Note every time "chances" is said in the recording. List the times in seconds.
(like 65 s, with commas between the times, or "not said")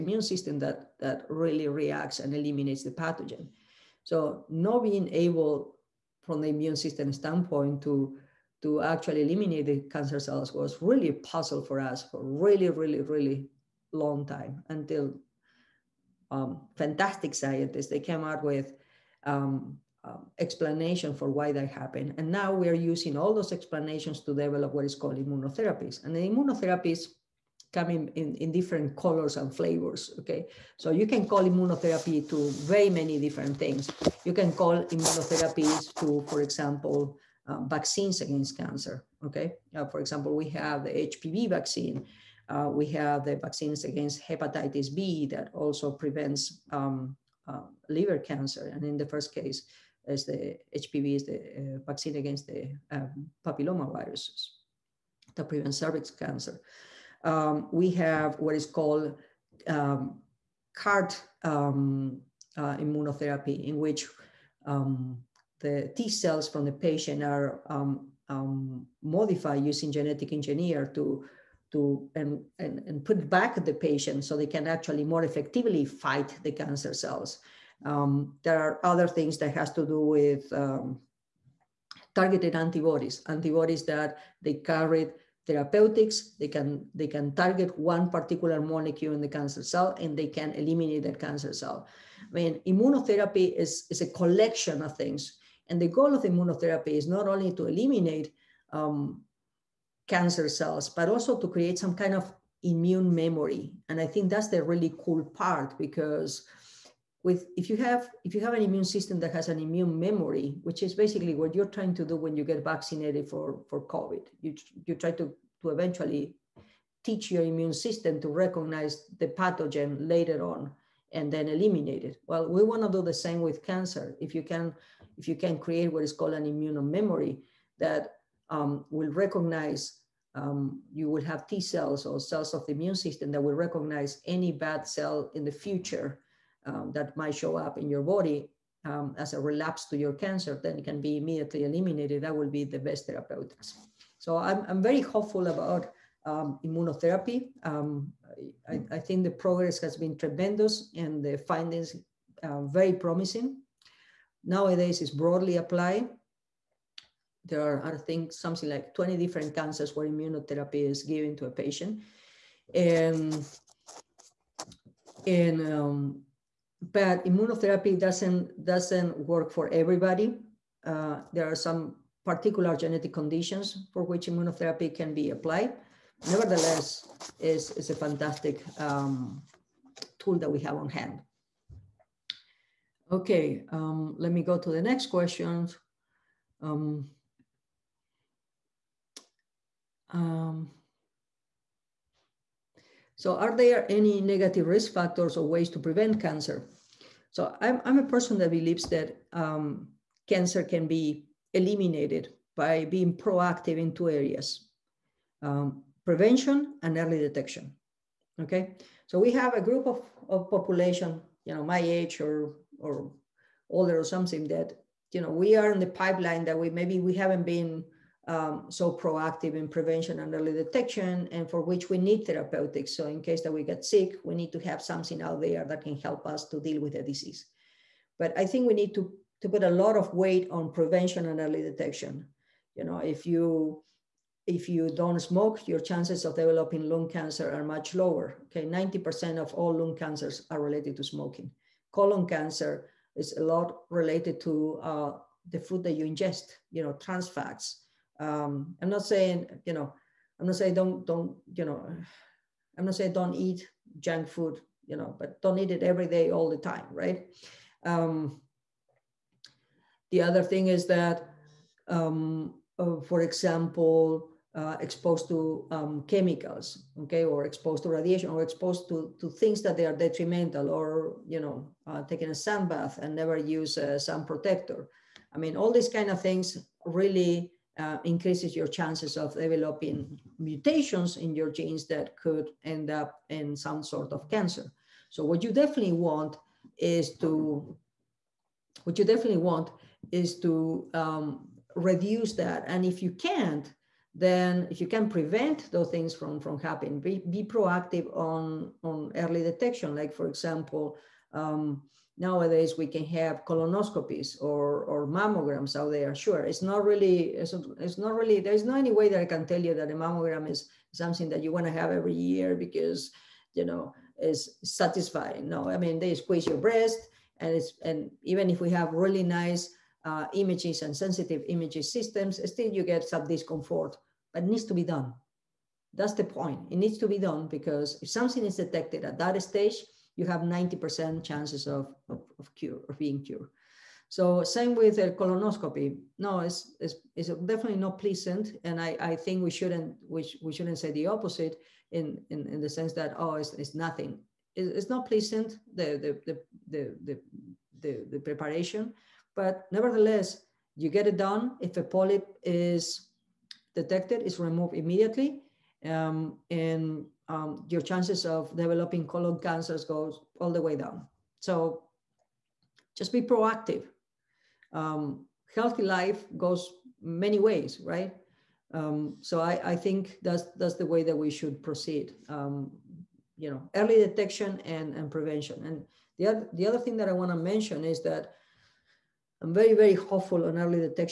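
235 s, 278 s, 331 s, 357 s.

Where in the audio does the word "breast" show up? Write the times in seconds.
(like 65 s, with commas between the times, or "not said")
316 s.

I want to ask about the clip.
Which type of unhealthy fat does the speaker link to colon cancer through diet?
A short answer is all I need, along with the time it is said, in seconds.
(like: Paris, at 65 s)
trans fats, at 246 s.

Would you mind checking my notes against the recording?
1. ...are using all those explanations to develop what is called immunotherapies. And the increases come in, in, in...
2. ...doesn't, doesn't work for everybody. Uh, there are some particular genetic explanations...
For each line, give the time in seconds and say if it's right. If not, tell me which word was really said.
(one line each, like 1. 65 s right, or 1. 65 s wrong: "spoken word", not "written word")
1. 22 s wrong: "immunotherapies", not "increases"
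2. 167 s wrong: "conditions", not "explanations".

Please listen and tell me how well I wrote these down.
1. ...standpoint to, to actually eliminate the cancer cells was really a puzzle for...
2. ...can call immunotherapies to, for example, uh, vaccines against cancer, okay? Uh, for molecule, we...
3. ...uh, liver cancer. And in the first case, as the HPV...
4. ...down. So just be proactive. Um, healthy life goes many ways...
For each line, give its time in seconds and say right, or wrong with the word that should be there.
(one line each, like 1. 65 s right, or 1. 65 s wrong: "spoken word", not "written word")
1. 7 s right
2. 34 s wrong: "example", not "molecule"
3. 47 s right
4. 360 s right.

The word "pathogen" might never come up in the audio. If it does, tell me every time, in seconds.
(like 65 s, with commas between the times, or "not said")
2 s, 119 s.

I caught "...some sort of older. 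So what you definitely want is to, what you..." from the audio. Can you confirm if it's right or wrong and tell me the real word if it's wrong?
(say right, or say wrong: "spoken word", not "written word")
wrong: "cancer", not "older".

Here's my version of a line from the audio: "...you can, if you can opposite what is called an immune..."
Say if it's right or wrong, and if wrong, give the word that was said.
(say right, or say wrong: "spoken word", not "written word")
wrong: "create", not "opposite".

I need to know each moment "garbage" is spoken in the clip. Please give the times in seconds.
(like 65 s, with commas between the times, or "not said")
not said.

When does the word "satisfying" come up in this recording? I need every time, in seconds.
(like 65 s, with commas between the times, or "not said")
314 s.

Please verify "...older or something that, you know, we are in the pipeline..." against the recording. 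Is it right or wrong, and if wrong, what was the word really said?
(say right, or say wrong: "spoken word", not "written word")
right.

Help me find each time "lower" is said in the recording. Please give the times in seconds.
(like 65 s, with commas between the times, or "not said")
237 s.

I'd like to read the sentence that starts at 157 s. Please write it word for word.
There are, I think, something like 20 different cancers where immunotherapy is given to a patient.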